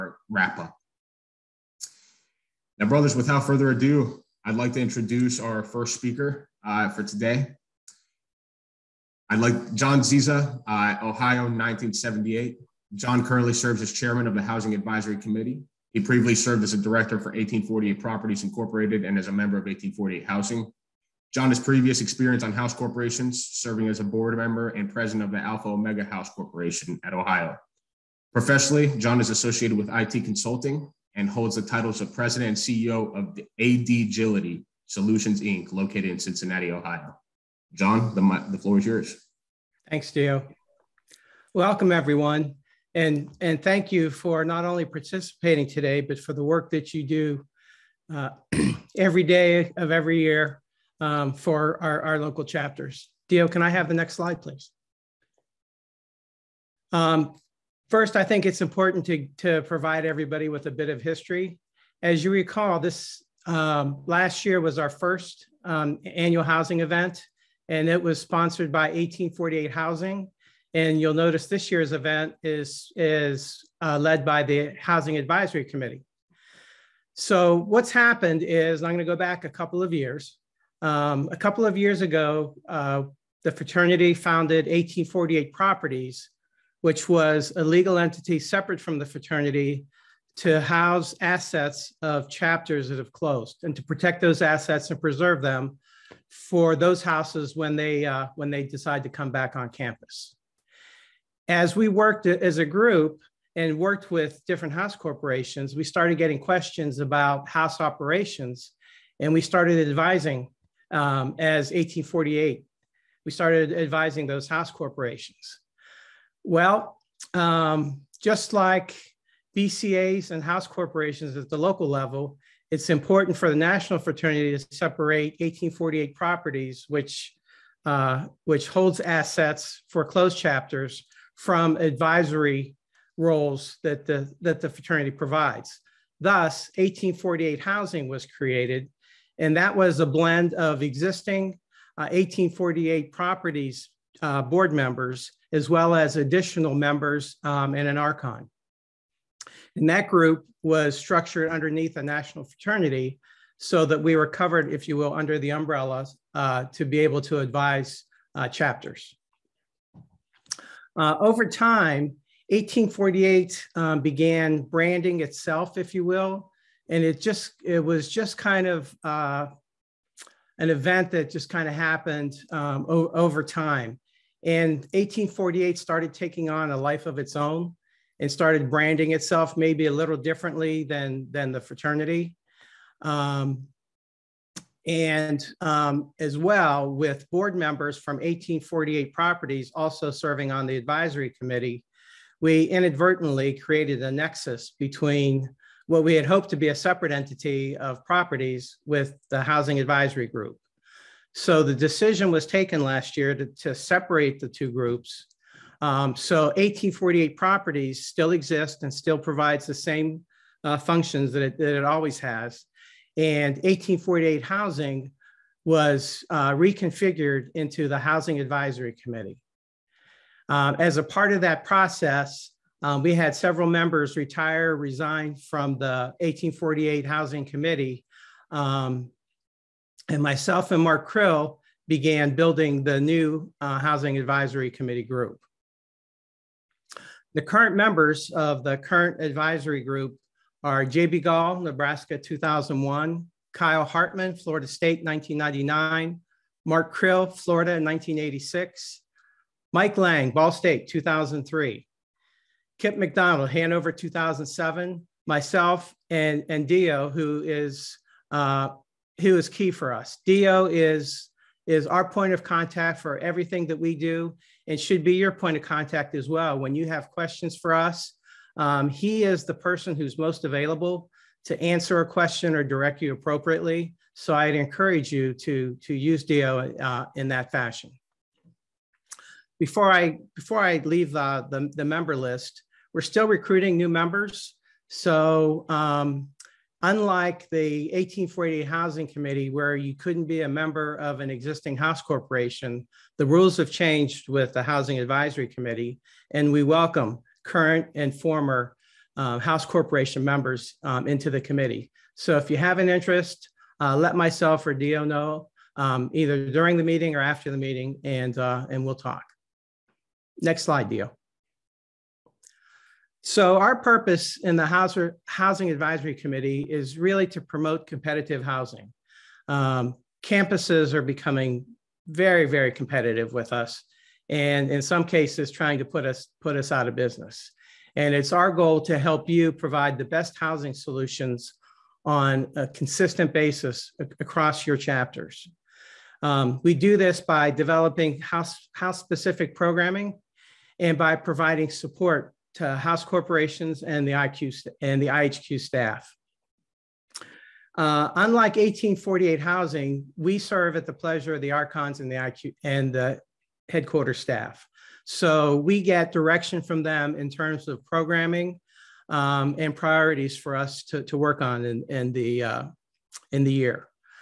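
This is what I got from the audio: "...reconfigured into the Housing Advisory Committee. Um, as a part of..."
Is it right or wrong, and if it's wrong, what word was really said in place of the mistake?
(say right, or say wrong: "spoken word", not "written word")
right.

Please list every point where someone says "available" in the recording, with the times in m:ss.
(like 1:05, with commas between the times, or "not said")
4:30.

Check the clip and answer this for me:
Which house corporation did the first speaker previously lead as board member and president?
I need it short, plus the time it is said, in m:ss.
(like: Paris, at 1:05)
Alpha Omega House Corporation, at 0:25.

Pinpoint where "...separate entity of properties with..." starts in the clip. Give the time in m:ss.
3:16.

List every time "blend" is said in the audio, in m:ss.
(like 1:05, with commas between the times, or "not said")
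2:20.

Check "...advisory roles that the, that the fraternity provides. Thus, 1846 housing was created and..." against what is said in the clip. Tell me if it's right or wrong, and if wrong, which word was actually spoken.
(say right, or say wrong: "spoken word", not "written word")
wrong: "1848", not "1846".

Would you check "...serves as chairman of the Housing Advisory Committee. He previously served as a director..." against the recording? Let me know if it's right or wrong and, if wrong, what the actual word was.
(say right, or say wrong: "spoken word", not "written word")
right.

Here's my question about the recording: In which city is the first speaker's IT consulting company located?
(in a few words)
Cincinnati.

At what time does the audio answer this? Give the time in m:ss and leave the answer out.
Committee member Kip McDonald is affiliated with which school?
4:13.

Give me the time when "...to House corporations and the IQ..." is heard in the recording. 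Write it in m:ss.
5:42.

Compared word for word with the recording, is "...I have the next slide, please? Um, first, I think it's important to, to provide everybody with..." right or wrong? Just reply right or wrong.
right.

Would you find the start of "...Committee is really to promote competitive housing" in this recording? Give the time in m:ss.
5:16.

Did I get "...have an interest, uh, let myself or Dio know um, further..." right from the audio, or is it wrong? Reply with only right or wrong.
wrong.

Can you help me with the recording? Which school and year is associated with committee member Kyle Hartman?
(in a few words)
Florida State 1999.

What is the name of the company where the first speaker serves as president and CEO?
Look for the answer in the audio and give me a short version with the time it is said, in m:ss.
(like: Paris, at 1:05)
AD Agility Solutions Inc., at 0:33.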